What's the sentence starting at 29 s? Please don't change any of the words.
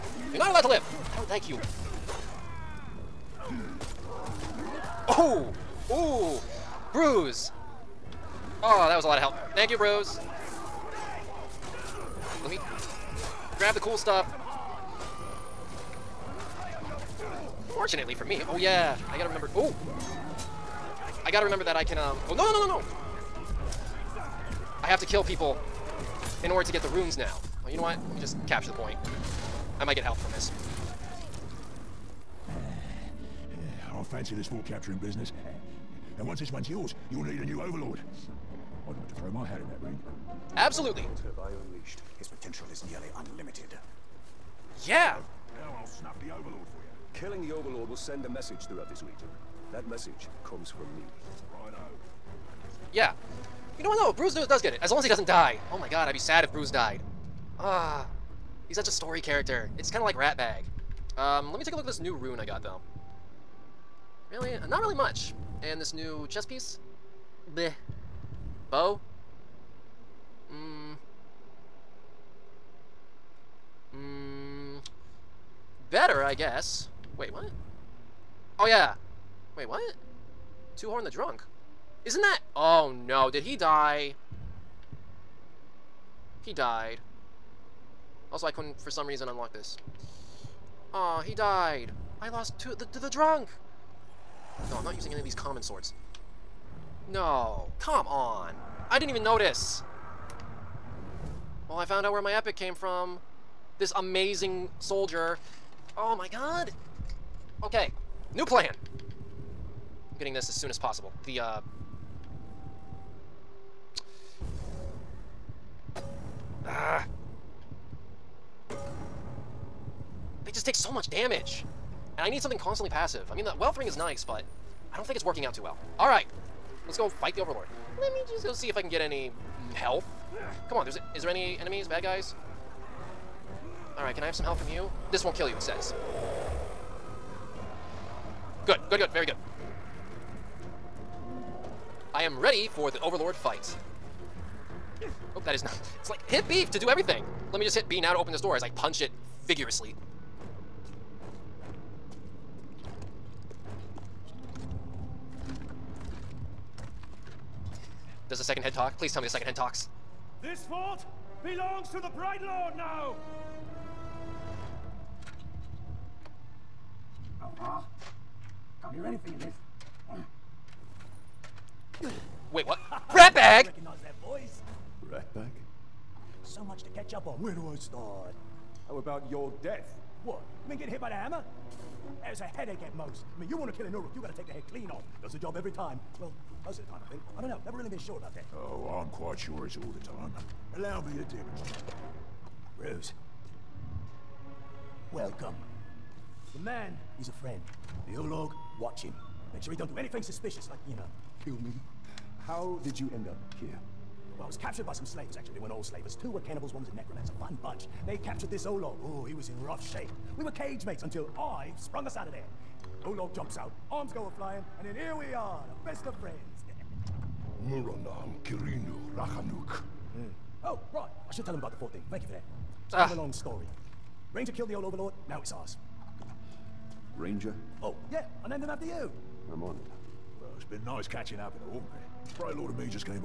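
I might get help from this.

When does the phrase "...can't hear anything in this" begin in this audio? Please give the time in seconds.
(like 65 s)
168 s.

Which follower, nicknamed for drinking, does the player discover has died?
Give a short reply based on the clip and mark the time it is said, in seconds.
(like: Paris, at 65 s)
Horn the Drunk, at 80 s.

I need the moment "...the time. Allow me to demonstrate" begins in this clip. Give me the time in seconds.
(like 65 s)
189 s.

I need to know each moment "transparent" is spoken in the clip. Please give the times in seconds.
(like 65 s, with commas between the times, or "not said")
not said.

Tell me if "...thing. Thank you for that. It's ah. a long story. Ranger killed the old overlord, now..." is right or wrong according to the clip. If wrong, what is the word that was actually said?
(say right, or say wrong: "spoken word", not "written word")
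right.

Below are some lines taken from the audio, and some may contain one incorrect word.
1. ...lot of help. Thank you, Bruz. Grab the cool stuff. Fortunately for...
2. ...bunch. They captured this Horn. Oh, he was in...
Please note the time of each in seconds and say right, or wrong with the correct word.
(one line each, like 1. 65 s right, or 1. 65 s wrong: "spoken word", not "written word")
1. 9 s right
2. 207 s wrong: "Olog", not "Horn".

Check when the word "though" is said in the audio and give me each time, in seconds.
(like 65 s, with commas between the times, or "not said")
54 s, 62 s.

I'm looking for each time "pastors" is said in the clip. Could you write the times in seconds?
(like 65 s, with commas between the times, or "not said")
not said.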